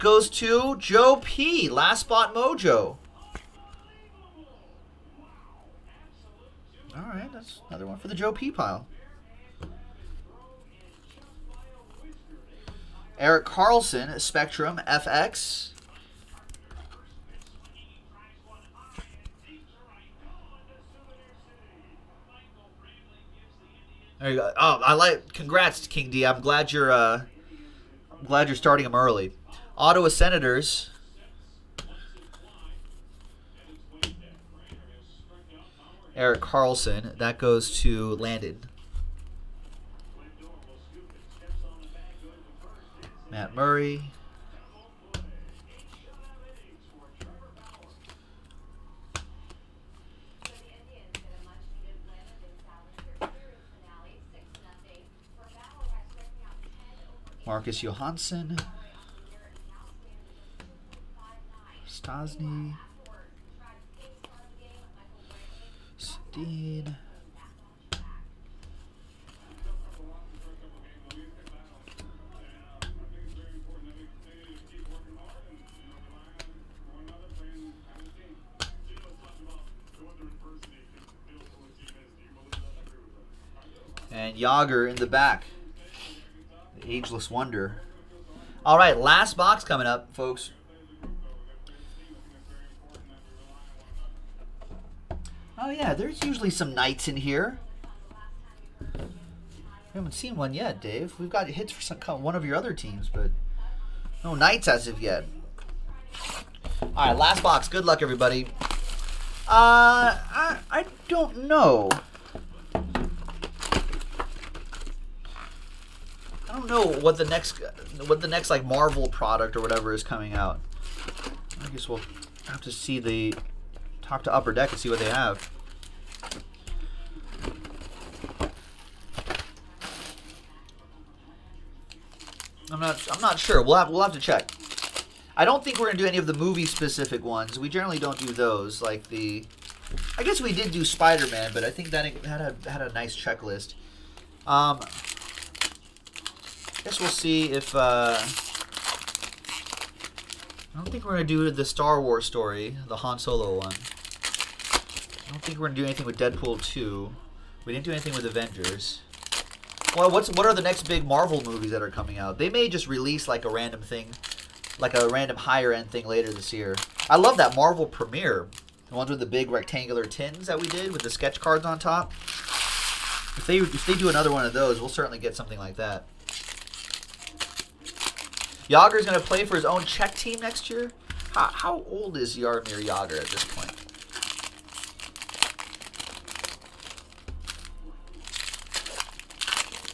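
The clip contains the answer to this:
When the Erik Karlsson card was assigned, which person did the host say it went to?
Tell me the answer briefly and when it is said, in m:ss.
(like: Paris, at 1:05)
Landon, at 0:38.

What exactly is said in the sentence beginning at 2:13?
We'll have we'll have to check.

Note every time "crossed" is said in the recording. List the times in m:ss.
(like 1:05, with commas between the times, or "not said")
not said.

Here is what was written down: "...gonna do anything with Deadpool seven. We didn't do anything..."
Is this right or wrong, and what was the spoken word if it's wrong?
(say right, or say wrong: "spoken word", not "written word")
wrong: "two", not "seven".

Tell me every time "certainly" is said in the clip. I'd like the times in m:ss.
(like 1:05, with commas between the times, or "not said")
2:54.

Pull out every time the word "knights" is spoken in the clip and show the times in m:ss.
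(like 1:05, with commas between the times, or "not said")
1:36, 1:44.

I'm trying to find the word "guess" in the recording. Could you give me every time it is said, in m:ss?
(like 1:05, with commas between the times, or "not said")
2:01, 2:20, 2:26.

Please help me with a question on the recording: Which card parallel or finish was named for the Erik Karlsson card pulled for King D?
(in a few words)
Spectrum FX.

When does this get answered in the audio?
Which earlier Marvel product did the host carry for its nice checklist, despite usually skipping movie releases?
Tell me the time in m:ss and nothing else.
2:20.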